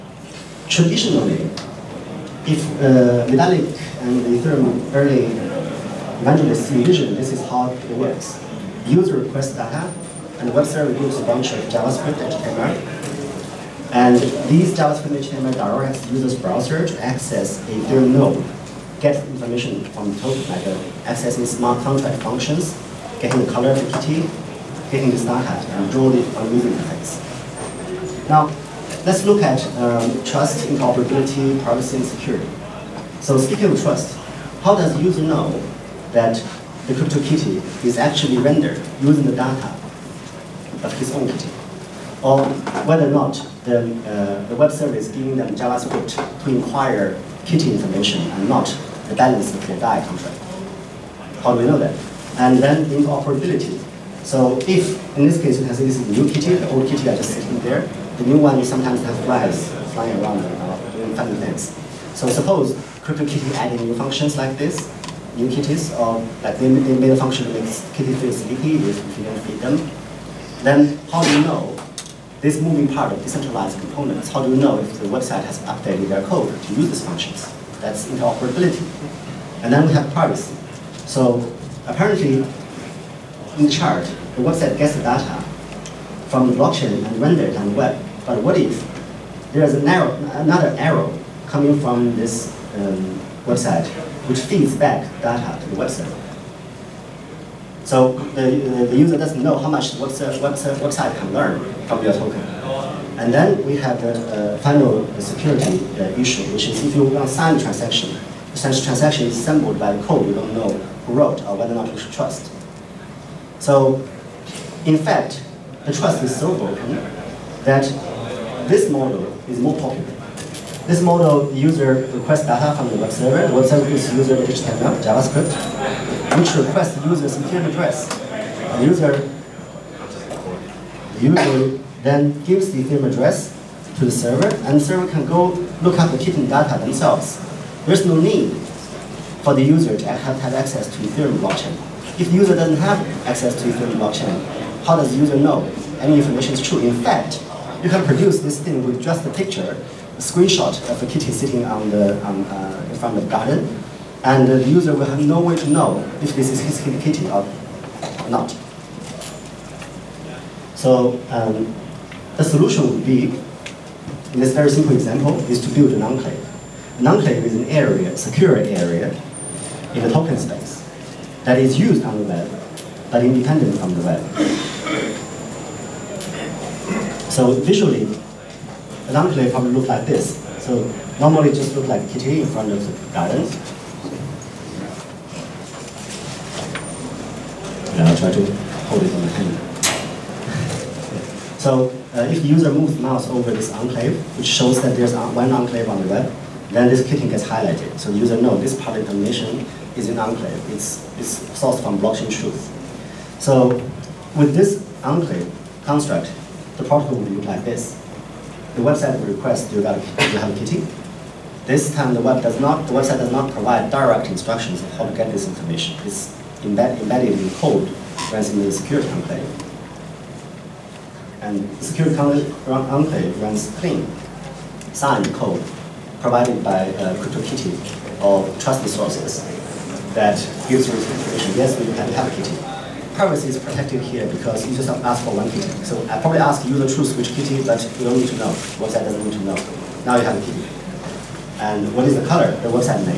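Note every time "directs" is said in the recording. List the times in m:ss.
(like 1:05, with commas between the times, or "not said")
0:15, 3:33.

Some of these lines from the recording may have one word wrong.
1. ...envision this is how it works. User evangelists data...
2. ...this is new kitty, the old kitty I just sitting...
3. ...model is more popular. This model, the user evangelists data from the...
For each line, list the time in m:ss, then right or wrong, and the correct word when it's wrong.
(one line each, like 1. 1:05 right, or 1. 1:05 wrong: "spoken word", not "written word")
1. 0:06 wrong: "requests", not "evangelists"
2. 0:55 right
3. 1:58 wrong: "requests", not "evangelists".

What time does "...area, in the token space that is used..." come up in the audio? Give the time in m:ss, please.
2:48.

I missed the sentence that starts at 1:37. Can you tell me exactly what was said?
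So the, the, the user doesn't know how much web, web, website can learn from your token.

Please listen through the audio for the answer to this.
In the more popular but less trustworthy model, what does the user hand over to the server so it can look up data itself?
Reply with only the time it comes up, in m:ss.
2:12.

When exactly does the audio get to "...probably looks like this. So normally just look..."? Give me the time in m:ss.
2:59.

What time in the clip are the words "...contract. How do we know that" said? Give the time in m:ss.
0:50.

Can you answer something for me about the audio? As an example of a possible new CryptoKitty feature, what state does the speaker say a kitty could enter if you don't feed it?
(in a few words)
Sleepy.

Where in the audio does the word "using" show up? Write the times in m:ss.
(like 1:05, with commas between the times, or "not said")
0:26, 0:39.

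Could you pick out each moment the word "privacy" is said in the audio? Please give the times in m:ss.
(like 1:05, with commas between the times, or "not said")
0:31, 1:20, 3:53.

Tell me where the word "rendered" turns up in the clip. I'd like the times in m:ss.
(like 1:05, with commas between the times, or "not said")
0:38, 1:27.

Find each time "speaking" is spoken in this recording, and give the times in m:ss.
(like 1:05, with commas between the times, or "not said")
0:33.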